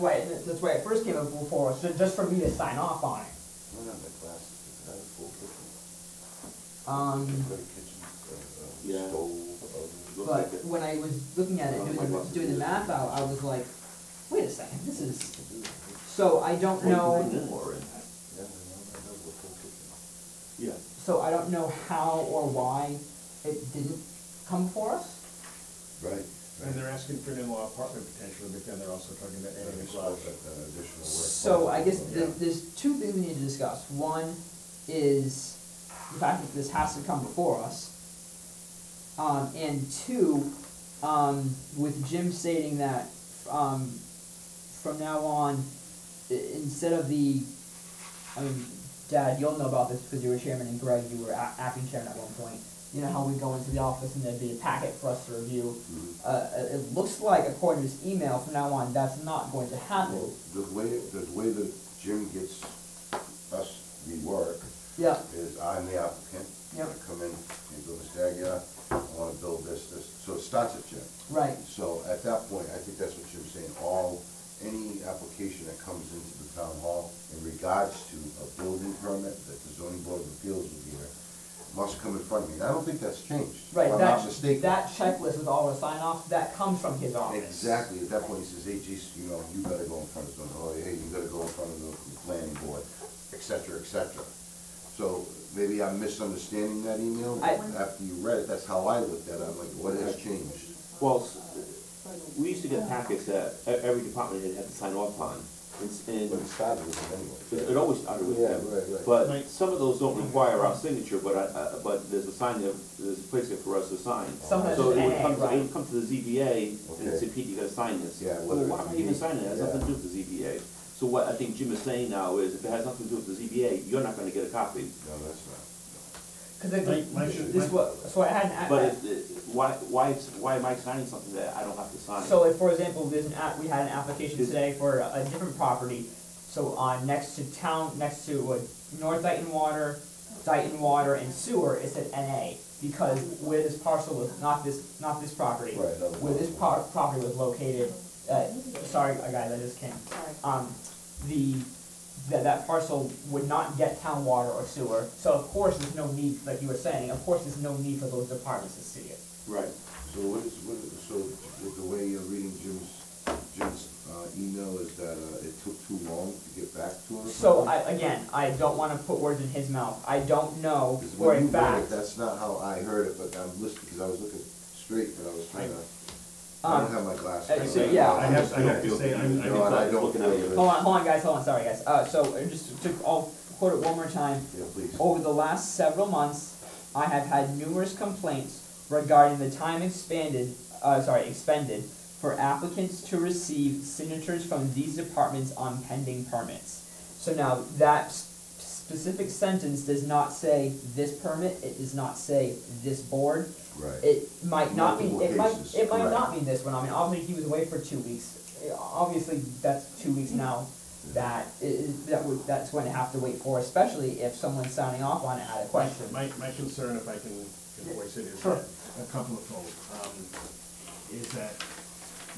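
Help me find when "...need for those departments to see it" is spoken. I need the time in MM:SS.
02:37.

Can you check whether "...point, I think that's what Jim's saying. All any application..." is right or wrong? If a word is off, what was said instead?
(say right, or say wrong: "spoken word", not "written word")
right.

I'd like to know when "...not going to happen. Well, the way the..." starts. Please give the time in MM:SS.
00:59.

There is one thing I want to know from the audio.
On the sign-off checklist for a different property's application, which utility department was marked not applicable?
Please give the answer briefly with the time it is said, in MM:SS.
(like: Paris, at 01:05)
Dighton Water and Sewer, at 02:20.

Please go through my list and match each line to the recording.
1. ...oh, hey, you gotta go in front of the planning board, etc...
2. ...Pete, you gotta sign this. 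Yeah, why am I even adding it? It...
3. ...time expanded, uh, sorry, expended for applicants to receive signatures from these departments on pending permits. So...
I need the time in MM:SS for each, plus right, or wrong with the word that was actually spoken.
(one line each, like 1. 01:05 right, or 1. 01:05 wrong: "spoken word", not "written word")
1. 01:30 right
2. 01:57 wrong: "signing", not "adding"
3. 03:09 right.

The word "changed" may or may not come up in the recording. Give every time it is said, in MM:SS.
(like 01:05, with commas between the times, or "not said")
01:23, 01:40.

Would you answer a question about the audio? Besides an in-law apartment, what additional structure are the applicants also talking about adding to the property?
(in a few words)
A garage.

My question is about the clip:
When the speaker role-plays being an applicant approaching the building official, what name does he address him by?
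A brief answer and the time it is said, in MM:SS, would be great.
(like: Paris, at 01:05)
Mr. Aguirre, at 01:07.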